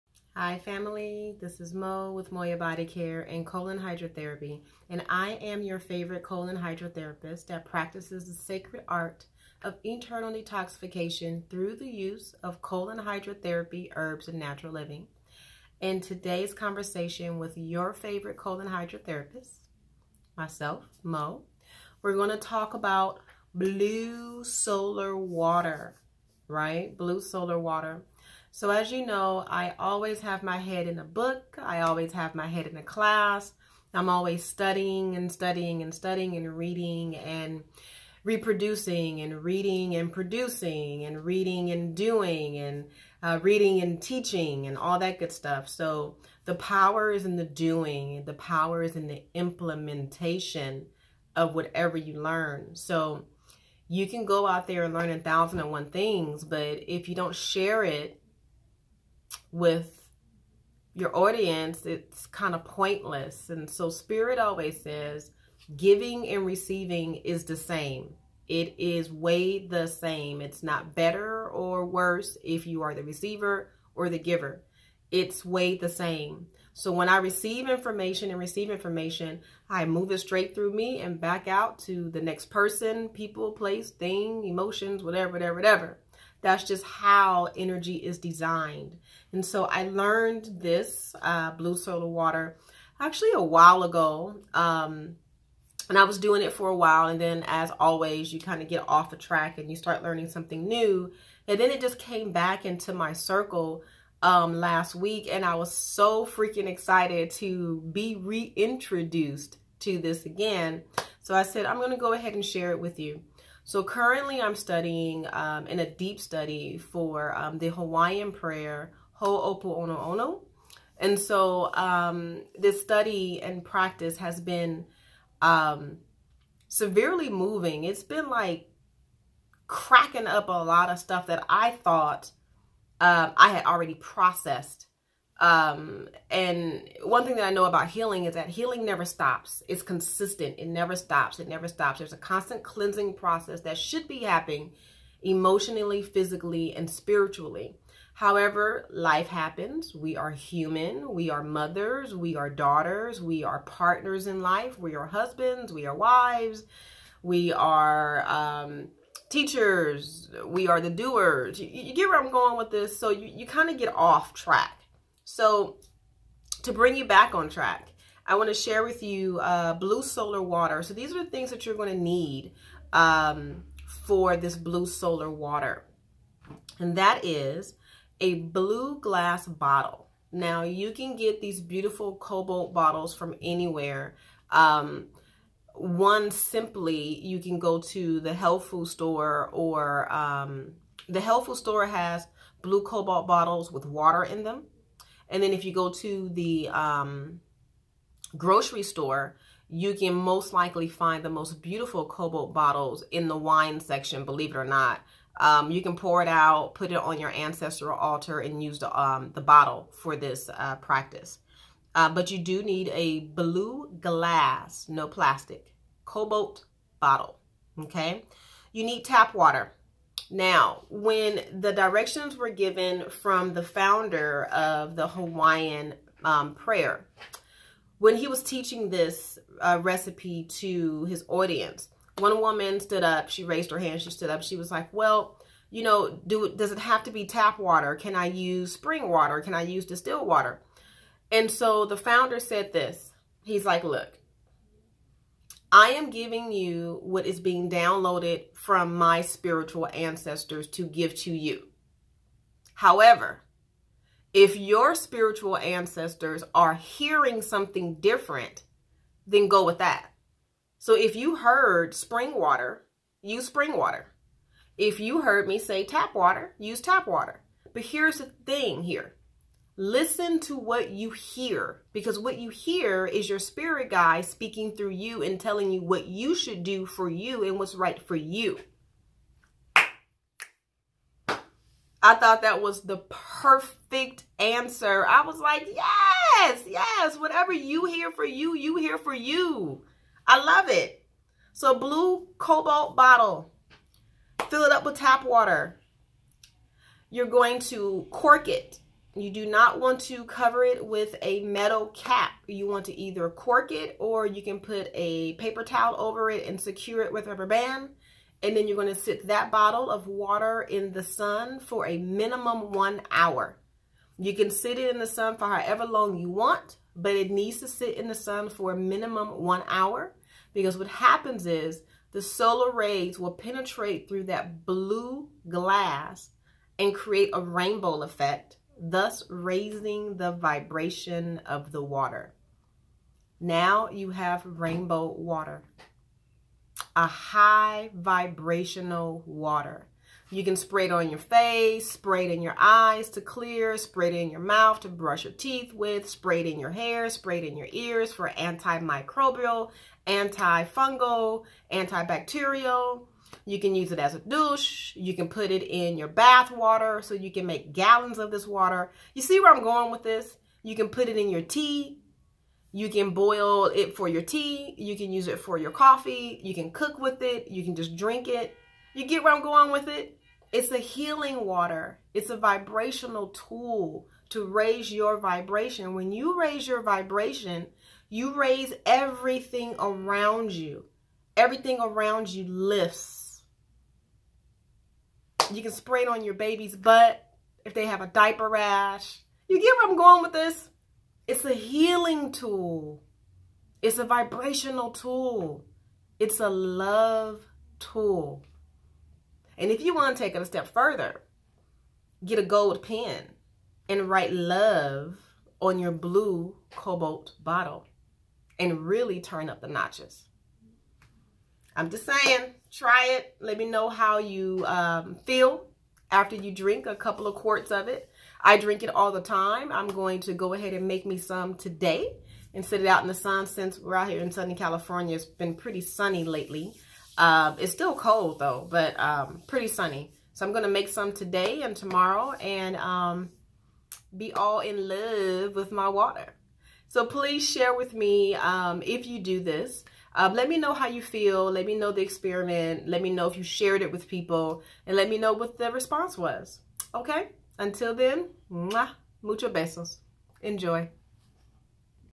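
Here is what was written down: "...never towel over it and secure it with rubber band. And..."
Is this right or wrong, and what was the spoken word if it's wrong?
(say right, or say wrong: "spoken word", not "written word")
wrong: "paper", not "never".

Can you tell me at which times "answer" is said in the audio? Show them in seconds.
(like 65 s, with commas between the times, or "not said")
284 s.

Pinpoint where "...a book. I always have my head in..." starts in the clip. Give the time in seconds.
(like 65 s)
30 s.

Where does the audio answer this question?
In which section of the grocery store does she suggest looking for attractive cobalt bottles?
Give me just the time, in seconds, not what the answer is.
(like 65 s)
203 s.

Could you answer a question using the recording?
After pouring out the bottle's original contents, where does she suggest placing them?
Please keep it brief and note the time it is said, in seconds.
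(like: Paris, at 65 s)
ancestral altar, at 207 s.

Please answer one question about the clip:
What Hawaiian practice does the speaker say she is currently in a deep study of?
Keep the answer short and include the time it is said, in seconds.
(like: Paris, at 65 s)
Hawaiian prayer, at 117 s.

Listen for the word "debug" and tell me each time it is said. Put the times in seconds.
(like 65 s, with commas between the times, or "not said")
not said.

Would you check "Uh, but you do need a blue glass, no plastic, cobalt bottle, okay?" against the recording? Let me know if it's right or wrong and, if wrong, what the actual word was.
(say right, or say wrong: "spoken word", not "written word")
right.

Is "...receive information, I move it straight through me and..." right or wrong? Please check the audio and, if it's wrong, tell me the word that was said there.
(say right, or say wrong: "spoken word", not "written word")
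right.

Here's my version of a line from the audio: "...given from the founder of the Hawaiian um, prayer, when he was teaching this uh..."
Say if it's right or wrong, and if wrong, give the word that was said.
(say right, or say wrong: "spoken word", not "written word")
right.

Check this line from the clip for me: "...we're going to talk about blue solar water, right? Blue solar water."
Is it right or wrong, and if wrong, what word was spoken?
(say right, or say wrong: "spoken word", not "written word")
right.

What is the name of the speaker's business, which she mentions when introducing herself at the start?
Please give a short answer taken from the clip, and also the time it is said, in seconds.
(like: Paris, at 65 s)
Moya Body Care, at 2 s.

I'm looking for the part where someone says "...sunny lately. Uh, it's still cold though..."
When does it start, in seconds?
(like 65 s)
425 s.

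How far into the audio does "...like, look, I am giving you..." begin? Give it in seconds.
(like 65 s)
243 s.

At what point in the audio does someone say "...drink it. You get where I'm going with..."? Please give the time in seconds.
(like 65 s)
367 s.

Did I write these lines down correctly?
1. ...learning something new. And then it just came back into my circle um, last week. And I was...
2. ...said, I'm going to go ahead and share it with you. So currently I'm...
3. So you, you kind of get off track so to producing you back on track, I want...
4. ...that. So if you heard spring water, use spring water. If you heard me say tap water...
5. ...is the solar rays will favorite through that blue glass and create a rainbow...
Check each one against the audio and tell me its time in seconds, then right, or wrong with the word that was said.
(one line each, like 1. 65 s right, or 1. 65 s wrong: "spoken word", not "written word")
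1. 100 s right
2. 111 s right
3. 162 s wrong: "bring", not "producing"
4. 259 s right
5. 321 s wrong: "penetrate", not "favorite".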